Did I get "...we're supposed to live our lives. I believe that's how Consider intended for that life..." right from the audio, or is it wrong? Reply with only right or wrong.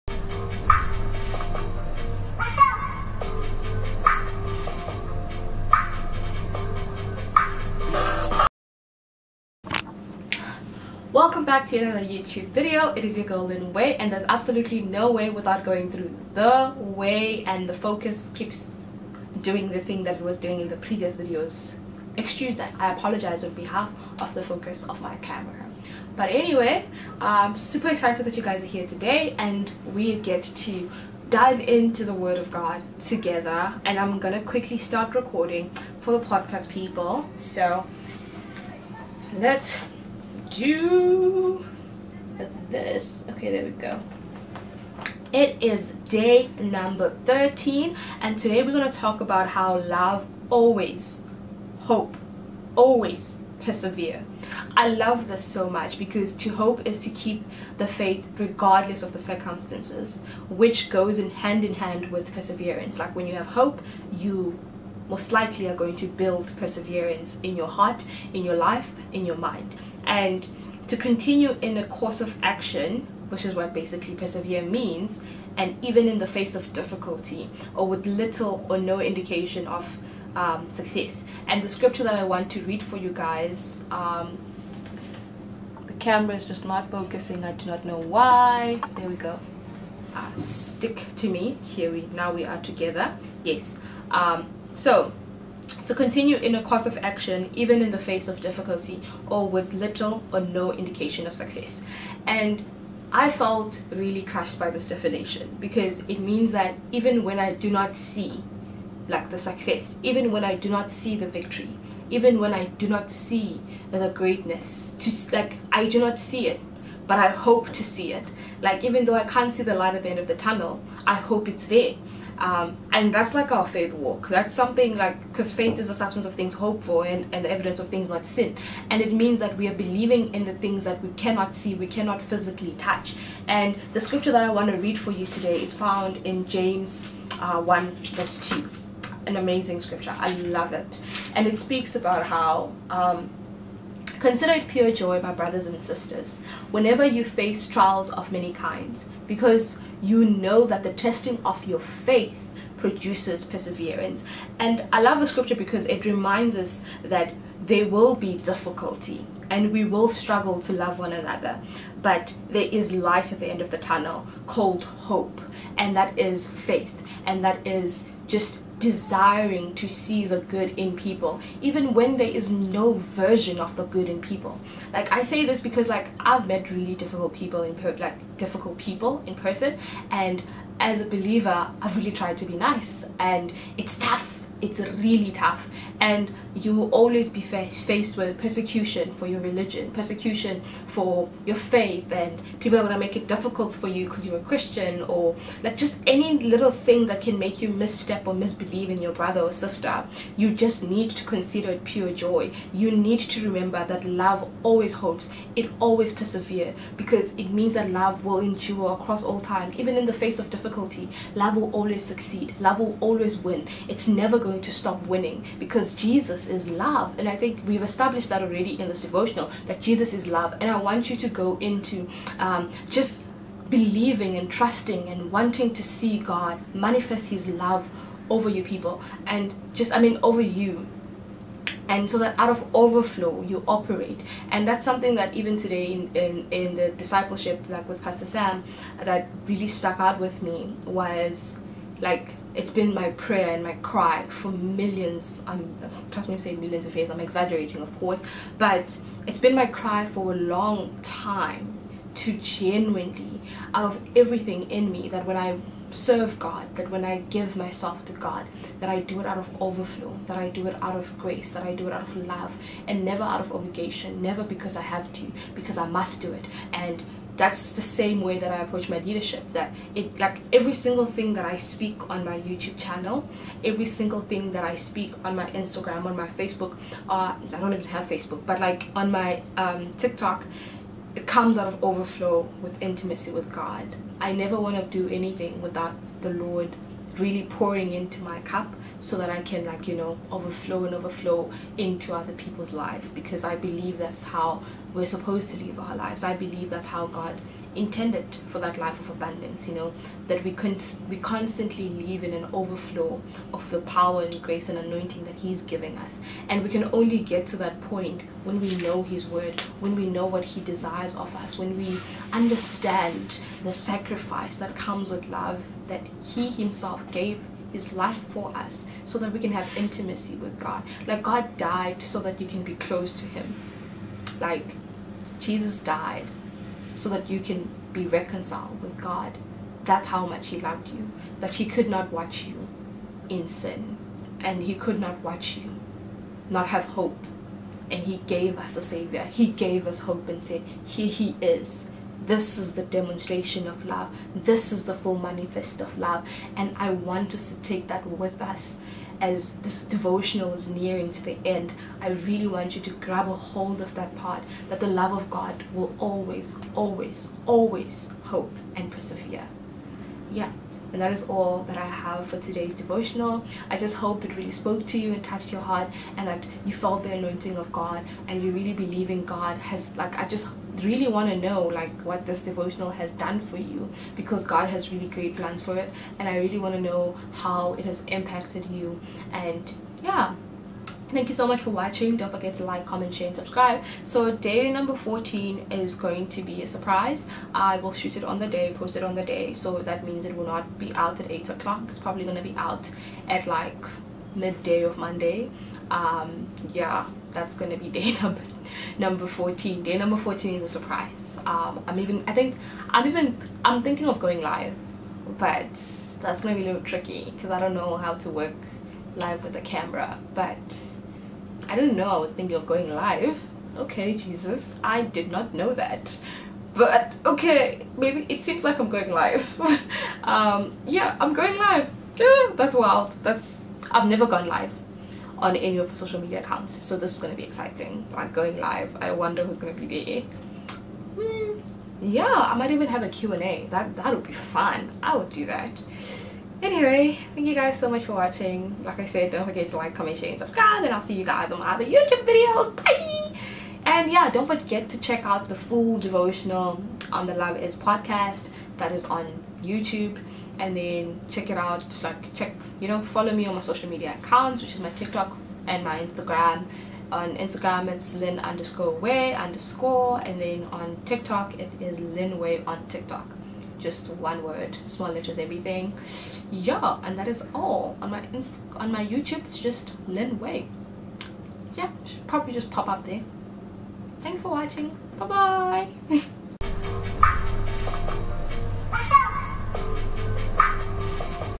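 wrong.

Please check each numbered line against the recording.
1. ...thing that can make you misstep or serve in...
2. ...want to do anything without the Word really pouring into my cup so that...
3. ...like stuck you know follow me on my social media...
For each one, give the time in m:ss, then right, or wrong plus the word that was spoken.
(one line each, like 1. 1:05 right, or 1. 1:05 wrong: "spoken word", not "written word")
1. 3:16 wrong: "misbelieve", not "serve"
2. 4:44 wrong: "Lord", not "Word"
3. 7:32 wrong: "check", not "stuck".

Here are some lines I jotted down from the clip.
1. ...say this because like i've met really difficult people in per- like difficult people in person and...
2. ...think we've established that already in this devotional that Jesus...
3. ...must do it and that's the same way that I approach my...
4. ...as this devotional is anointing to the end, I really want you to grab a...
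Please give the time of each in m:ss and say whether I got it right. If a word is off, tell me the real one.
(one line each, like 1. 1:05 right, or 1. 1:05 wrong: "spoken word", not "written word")
1. 2:55 right
2. 3:37 right
3. 4:25 right
4. 5:49 wrong: "nearing", not "anointing".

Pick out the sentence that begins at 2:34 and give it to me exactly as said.
And I love the scripture because it reminds us that there will be difficulty and we will struggle to love one another.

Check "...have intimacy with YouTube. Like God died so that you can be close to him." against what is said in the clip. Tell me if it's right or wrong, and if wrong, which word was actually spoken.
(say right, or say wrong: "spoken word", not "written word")
wrong: "God", not "YouTube".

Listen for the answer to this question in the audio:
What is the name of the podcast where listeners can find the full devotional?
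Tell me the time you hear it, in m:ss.
7:27.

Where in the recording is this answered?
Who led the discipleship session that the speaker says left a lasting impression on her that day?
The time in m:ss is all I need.
3:58.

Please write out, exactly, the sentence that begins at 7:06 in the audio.
So this is going to be exciting, like going live.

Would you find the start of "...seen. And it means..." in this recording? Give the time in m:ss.
2:08.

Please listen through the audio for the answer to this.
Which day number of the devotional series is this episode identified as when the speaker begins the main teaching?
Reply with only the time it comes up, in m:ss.
0:46.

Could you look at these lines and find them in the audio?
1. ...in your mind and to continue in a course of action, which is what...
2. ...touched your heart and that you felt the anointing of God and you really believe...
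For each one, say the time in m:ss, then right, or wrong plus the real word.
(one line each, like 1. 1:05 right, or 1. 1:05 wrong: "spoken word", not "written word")
1. 1:09 right
2. 6:05 right.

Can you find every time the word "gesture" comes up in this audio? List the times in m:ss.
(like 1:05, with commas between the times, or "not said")
not said.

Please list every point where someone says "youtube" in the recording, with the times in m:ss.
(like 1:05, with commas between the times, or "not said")
0:12, 4:32, 7:21, 7:29, 7:49.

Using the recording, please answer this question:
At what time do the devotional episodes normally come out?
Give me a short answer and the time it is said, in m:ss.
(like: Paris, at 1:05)
8 o'clock, at 6:31.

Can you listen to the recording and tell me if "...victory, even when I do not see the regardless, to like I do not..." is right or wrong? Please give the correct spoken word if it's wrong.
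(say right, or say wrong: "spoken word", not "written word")
wrong: "greatness", not "regardless".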